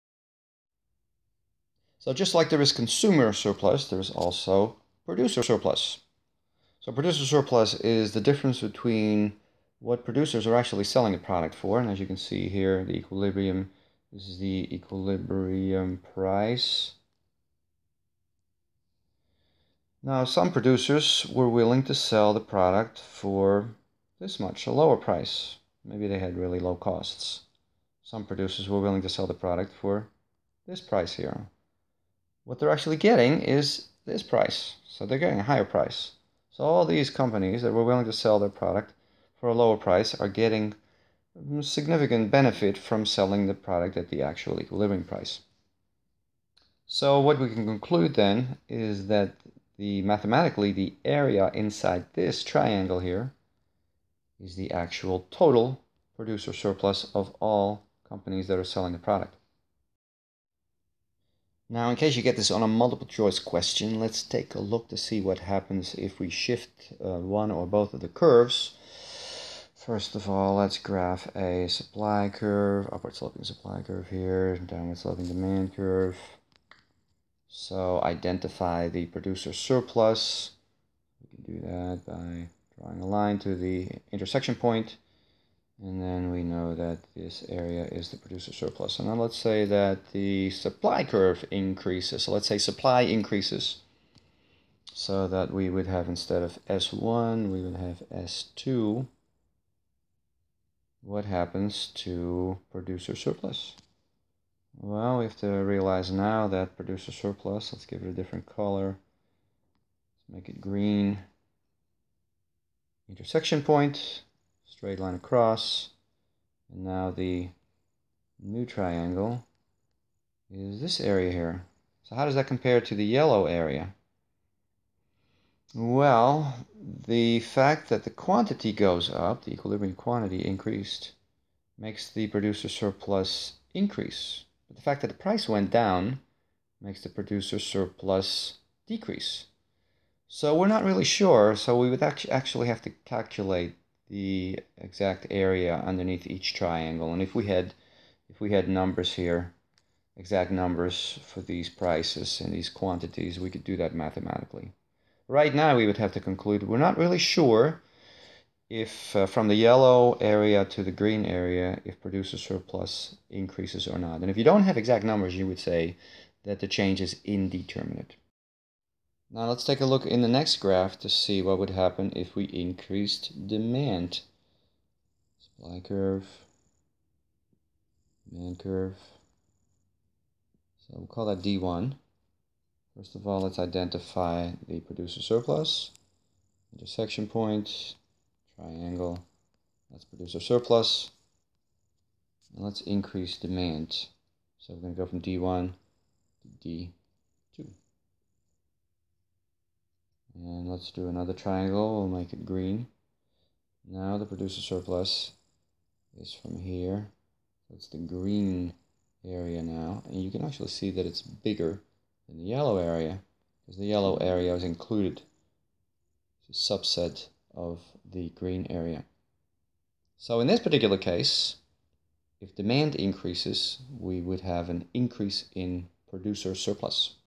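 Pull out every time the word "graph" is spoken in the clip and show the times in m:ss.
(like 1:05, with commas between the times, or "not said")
1:10, 2:50.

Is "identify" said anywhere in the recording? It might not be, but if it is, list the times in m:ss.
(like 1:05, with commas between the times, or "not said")
1:18, 3:03.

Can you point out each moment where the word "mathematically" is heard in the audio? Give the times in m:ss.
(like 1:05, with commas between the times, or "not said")
0:50, 2:33.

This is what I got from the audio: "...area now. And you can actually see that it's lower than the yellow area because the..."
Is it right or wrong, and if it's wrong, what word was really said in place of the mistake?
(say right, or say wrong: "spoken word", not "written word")
wrong: "bigger", not "lower".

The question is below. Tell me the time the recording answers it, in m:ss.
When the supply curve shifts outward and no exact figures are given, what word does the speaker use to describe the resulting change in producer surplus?
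2:47.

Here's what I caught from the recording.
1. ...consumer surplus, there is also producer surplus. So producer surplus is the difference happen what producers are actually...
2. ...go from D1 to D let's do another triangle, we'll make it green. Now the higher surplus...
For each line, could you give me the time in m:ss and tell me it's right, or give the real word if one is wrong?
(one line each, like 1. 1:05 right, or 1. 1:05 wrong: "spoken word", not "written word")
1. 0:02 wrong: "between", not "happen"
2. 3:15 wrong: "producer", not "higher".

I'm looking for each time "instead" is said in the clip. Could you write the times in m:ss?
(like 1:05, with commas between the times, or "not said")
1:36.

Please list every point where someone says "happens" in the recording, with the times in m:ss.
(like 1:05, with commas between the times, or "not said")
1:05, 1:41, 2:51.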